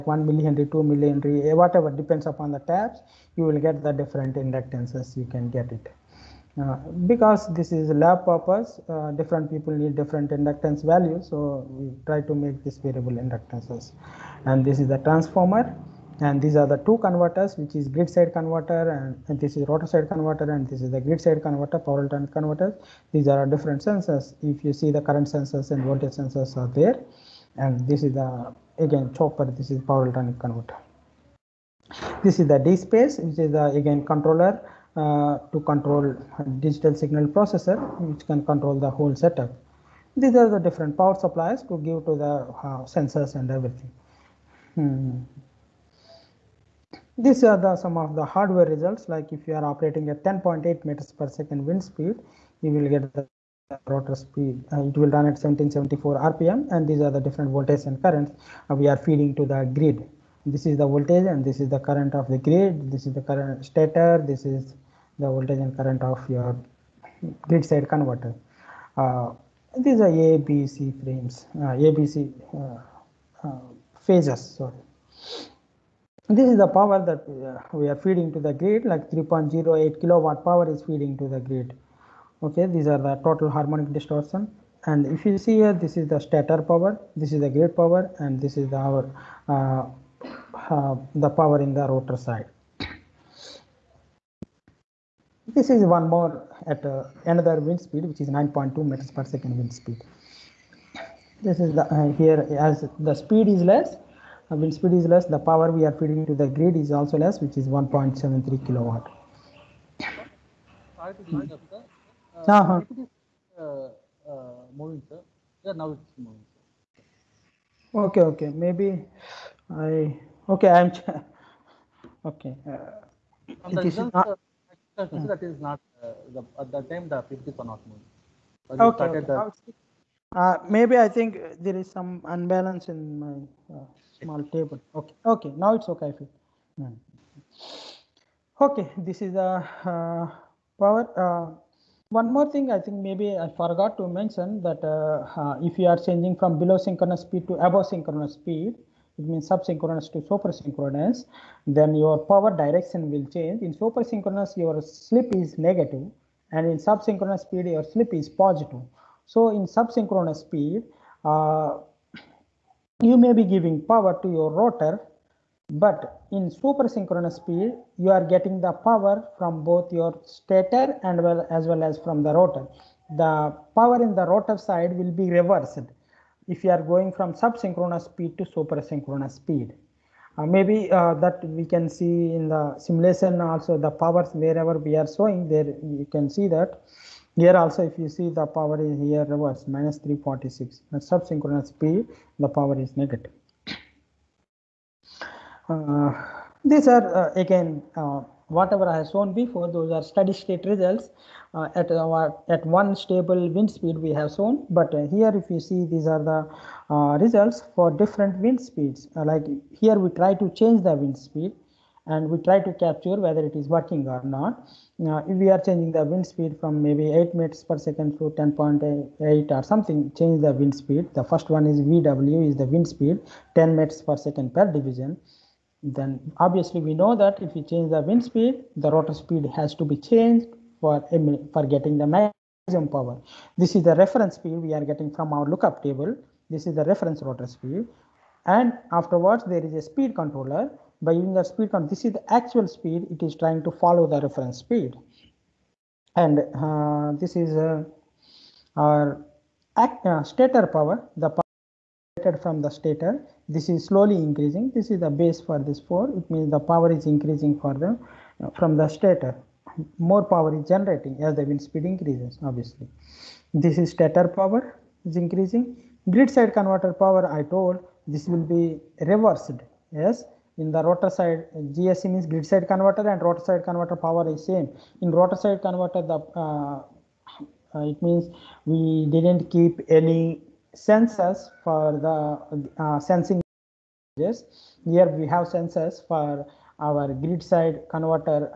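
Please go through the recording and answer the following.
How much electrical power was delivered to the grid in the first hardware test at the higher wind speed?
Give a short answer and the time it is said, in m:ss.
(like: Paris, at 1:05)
3.08 kilowatt, at 1:19.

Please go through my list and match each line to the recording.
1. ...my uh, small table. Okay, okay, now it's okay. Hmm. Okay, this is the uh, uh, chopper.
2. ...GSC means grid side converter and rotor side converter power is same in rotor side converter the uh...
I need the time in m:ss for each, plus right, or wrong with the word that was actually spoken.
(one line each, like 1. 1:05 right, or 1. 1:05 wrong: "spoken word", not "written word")
1. 2:13 wrong: "power", not "chopper"
2. 4:31 right.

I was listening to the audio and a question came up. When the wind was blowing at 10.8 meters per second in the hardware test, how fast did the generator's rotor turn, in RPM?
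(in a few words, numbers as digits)
1774.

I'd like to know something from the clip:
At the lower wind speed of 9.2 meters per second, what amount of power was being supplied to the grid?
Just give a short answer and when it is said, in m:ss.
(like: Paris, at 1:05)
1.73 kilowatt, at 1:47.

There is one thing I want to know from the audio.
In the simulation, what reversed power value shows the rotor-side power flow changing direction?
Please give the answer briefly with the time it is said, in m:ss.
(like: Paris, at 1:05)
-346, at 3:09.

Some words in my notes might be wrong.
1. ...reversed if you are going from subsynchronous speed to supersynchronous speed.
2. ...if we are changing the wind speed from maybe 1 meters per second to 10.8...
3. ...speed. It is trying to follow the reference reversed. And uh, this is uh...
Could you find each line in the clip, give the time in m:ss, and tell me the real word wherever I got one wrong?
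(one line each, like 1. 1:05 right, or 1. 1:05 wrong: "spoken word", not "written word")
1. 2:55 right
2. 3:35 wrong: "8", not "1"
3. 4:02 wrong: "speed", not "reversed".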